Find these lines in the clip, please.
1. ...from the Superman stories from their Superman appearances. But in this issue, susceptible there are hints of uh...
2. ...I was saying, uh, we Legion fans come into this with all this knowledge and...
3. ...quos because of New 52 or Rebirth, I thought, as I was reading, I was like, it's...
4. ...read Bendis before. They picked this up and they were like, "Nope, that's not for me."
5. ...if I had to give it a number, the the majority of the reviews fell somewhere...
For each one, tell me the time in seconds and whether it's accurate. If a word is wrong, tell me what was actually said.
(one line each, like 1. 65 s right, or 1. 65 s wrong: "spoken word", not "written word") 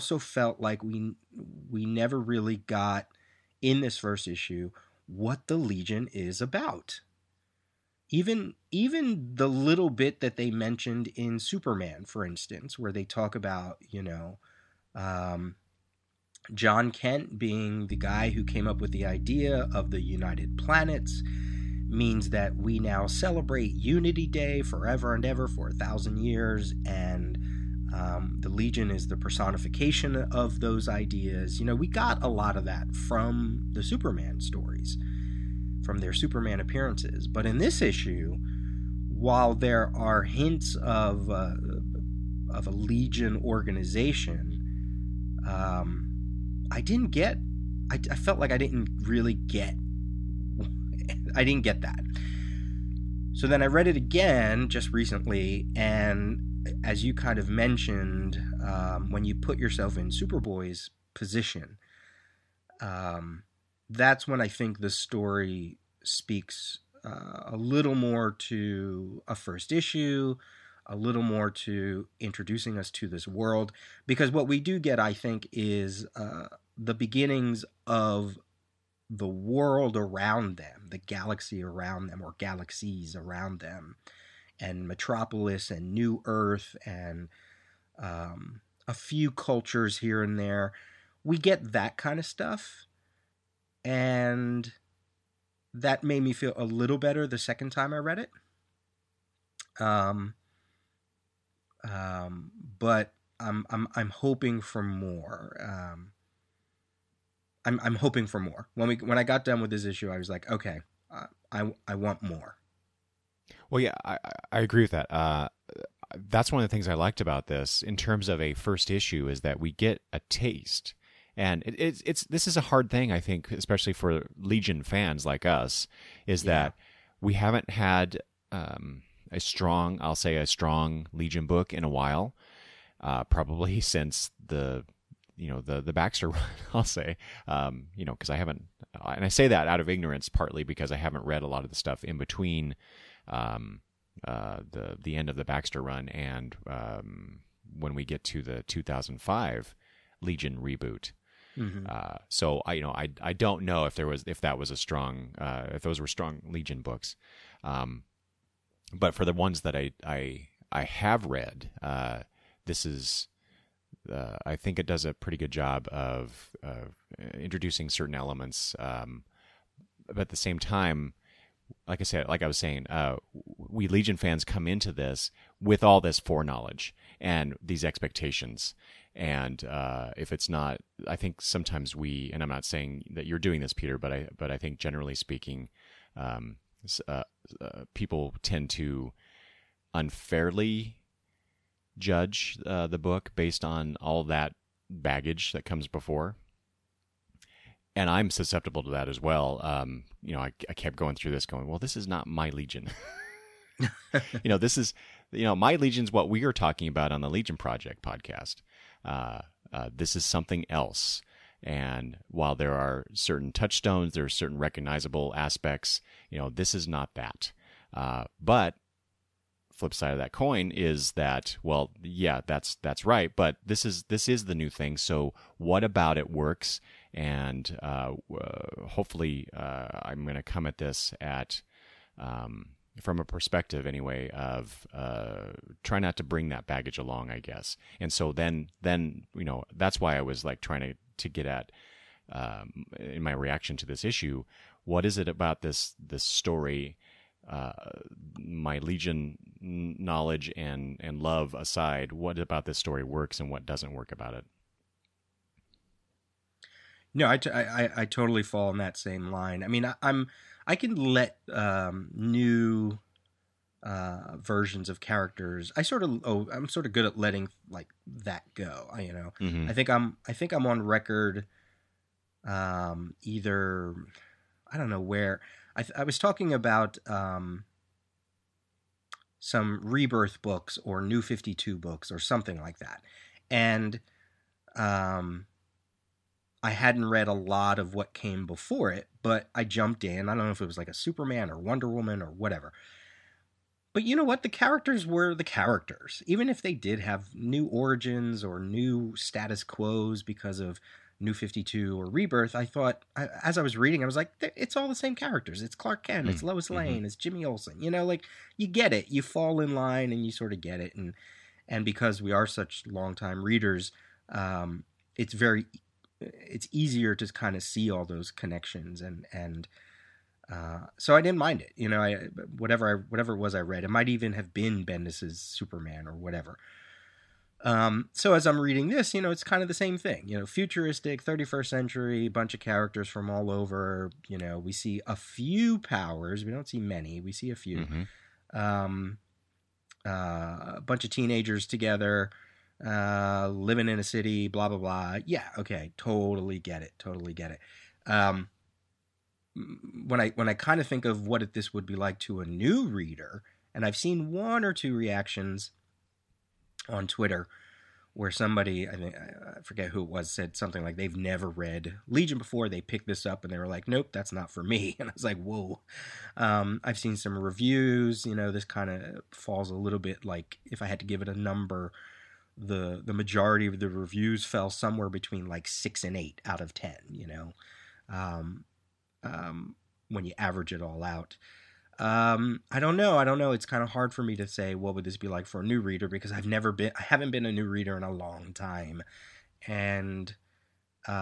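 1. 32 s wrong: "while", not "susceptible"
2. 172 s wrong: "foreknowledge", not "knowledge"
3. 299 s right
4. 361 s wrong: "Legion", not "Bendis"
5. 370 s right.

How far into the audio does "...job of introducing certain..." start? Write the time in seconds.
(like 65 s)
165 s.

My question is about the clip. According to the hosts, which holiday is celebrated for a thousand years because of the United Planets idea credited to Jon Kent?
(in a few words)
Unity Day.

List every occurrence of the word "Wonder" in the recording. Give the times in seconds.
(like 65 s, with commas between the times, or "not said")
291 s.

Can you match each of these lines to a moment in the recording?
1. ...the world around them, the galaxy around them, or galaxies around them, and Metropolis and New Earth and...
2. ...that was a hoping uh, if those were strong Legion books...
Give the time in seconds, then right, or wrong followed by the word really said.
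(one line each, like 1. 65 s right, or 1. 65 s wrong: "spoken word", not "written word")
1. 79 s right
2. 154 s wrong: "strong", not "hoping".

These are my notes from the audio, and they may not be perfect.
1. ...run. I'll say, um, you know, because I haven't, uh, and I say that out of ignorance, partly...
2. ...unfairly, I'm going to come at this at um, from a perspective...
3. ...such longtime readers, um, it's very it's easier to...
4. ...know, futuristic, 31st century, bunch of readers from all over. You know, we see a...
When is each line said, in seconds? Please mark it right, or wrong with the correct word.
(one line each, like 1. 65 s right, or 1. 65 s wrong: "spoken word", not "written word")
1. 136 s right
2. 228 s wrong: "hopefully", not "unfairly"
3. 312 s right
4. 330 s wrong: "characters", not "readers".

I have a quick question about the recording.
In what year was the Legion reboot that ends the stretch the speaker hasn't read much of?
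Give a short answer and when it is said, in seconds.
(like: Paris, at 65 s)
2005, at 148 s.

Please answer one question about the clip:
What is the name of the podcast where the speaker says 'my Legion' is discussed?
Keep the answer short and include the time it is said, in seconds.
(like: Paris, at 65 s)
Legion Project podcast, at 207 s.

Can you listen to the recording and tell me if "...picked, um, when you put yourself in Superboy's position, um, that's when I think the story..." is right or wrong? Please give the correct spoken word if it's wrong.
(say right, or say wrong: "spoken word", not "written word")
wrong: "mentioned", not "picked".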